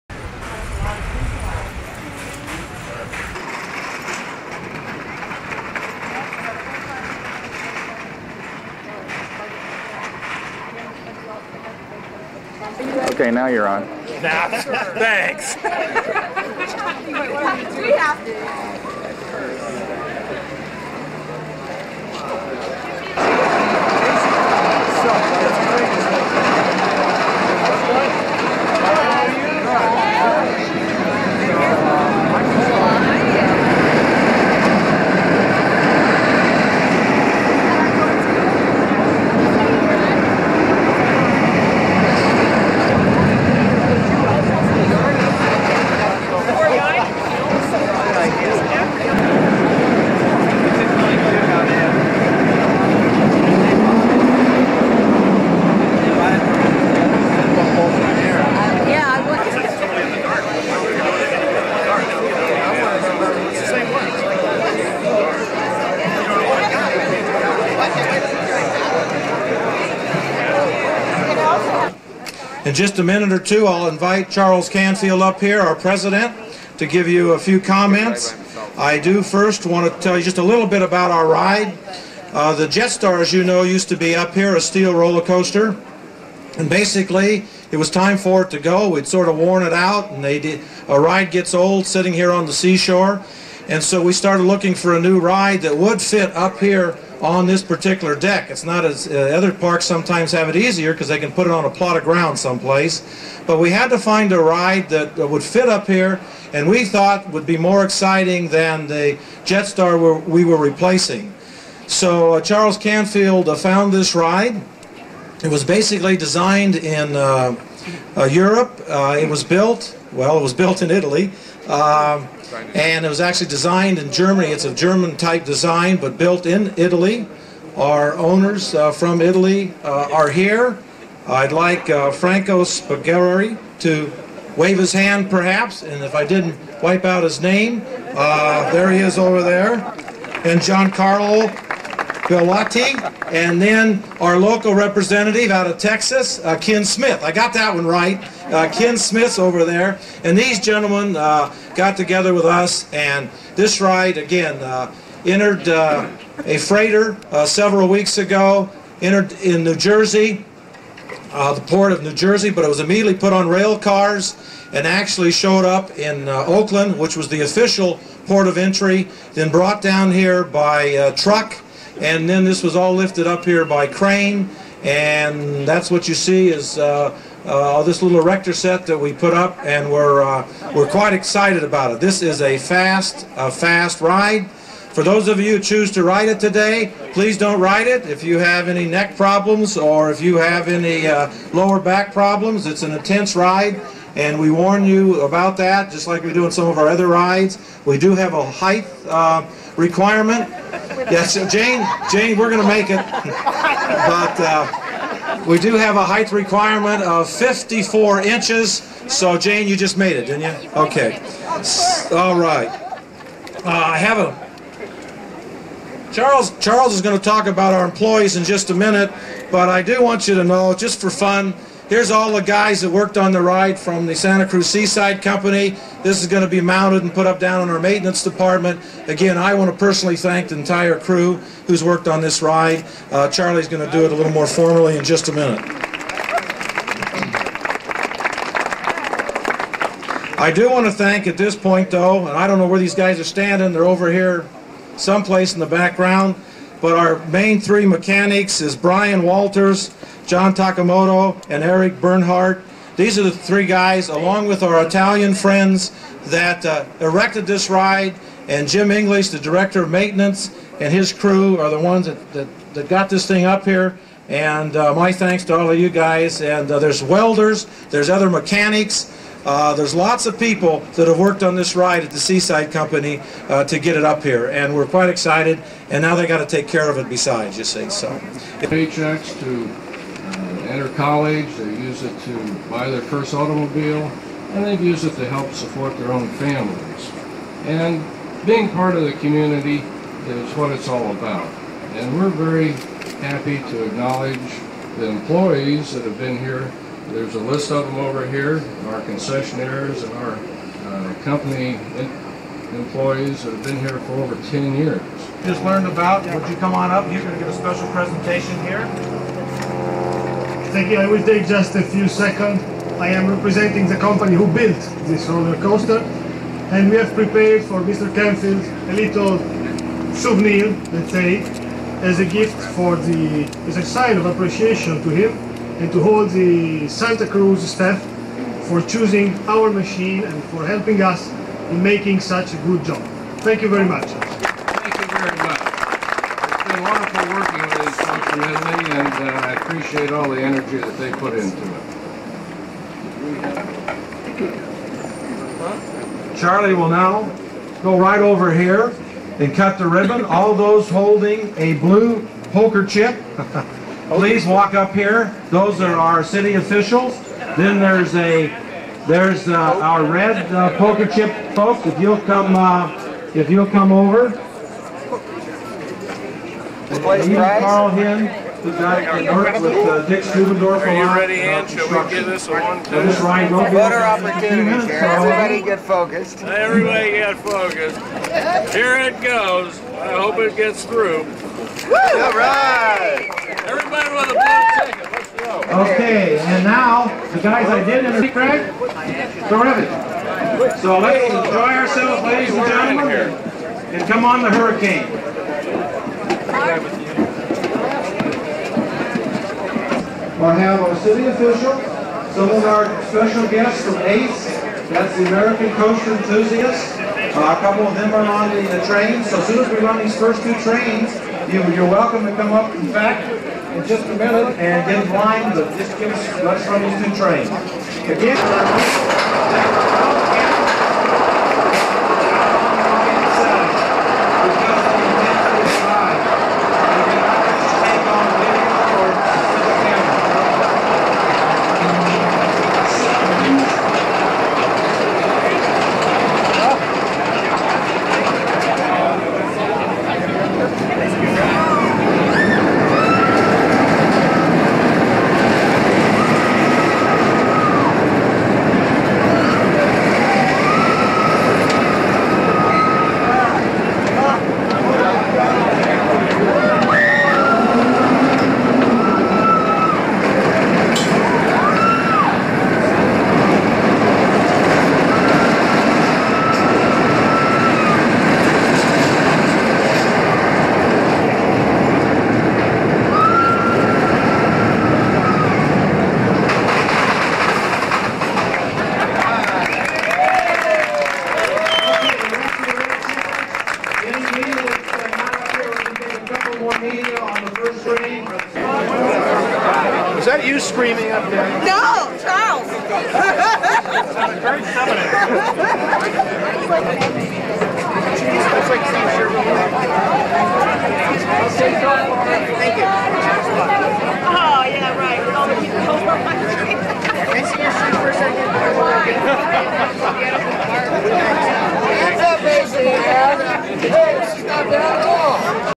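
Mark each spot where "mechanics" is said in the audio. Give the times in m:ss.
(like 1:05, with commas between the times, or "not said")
4:07, 4:28.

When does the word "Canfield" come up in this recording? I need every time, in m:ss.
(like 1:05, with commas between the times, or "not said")
1:14, 1:52, 5:18.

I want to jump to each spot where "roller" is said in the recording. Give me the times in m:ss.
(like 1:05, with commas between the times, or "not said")
1:24, 5:15.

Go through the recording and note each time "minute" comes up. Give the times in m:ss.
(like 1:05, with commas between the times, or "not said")
1:13, 3:38, 3:55, 6:54.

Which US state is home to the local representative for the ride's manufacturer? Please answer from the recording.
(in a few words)
Texas.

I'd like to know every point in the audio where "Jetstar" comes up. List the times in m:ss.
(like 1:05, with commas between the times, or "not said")
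1:22, 1:49.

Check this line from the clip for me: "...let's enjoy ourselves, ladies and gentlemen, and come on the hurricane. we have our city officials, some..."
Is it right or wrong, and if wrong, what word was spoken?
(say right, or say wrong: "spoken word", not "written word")
right.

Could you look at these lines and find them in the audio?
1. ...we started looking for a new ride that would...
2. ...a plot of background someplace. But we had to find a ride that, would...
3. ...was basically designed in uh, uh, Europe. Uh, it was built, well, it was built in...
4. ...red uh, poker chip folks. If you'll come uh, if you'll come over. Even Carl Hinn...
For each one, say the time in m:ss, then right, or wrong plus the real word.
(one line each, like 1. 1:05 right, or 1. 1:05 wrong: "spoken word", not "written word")
1. 1:34 right
2. 1:41 wrong: "ground", not "background"
3. 1:55 right
4. 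6:00 right.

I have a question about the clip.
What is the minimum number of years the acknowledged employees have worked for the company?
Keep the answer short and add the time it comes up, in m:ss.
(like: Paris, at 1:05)
10 years, at 5:04.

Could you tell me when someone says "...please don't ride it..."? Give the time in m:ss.
3:07.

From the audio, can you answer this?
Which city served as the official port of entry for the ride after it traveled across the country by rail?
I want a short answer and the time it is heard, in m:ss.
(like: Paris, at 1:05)
Oakland, at 2:44.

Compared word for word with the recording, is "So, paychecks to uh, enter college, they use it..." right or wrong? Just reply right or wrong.
right.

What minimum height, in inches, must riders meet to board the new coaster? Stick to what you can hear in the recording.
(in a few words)
54 inches.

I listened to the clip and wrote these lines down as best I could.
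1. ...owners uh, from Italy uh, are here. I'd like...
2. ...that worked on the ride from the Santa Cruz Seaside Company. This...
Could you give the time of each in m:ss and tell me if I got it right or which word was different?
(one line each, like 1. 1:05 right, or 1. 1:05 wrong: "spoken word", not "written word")
1. 2:08 right
2. 3:42 right.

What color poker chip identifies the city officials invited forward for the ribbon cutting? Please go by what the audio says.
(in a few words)
Blue.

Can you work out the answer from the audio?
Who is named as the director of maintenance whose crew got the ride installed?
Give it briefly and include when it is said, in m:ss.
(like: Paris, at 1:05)
Jim English, at 4:18.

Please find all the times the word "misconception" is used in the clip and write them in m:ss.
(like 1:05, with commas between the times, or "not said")
not said.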